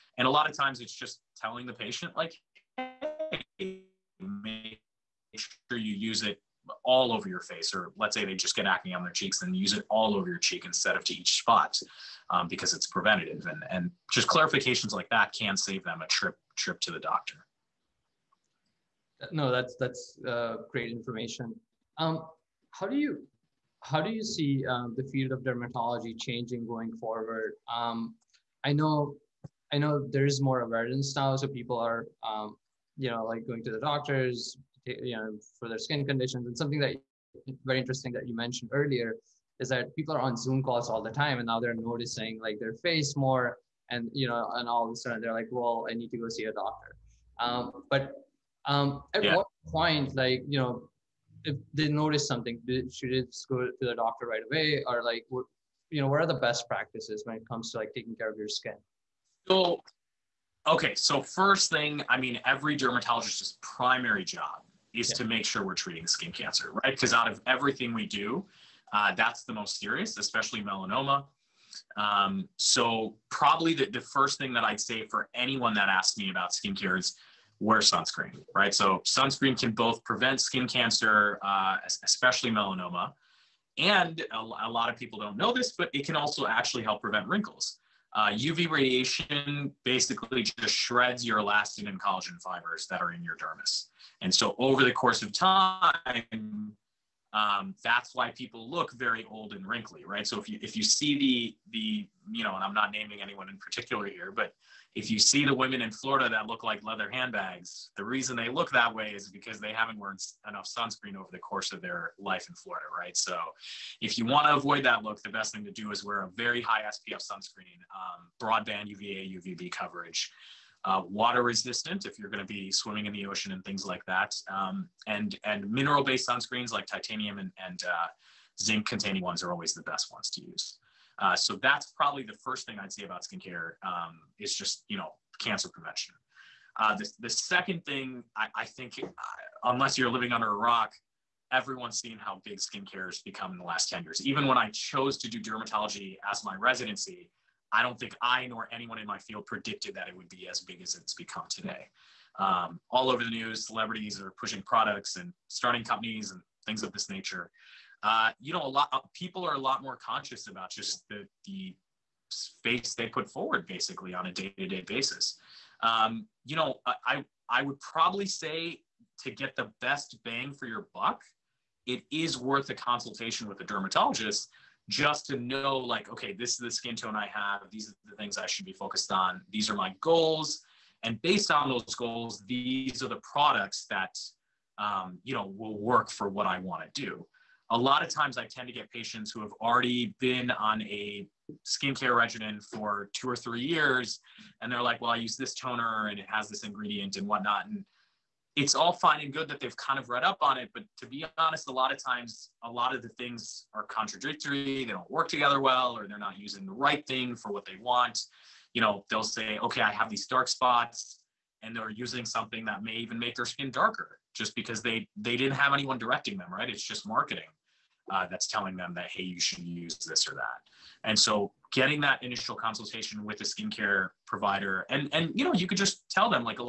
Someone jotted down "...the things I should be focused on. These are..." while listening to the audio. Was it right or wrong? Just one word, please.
right.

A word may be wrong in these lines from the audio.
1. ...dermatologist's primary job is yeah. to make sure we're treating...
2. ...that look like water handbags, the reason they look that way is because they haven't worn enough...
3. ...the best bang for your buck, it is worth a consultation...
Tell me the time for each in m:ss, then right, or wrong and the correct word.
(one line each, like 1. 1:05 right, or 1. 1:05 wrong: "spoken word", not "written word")
1. 1:02 right
2. 1:46 wrong: "leather", not "water"
3. 2:49 right.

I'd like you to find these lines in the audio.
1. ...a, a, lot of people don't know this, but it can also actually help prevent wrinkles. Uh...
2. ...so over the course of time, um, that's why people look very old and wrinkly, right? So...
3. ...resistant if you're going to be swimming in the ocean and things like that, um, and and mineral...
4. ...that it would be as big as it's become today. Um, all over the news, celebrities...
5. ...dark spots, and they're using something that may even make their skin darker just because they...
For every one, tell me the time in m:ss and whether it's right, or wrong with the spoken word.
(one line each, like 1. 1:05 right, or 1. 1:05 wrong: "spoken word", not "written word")
1. 1:24 right
2. 1:34 right
3. 2:01 right
4. 2:29 right
5. 3:30 right.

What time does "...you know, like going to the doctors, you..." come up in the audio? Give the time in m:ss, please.
0:32.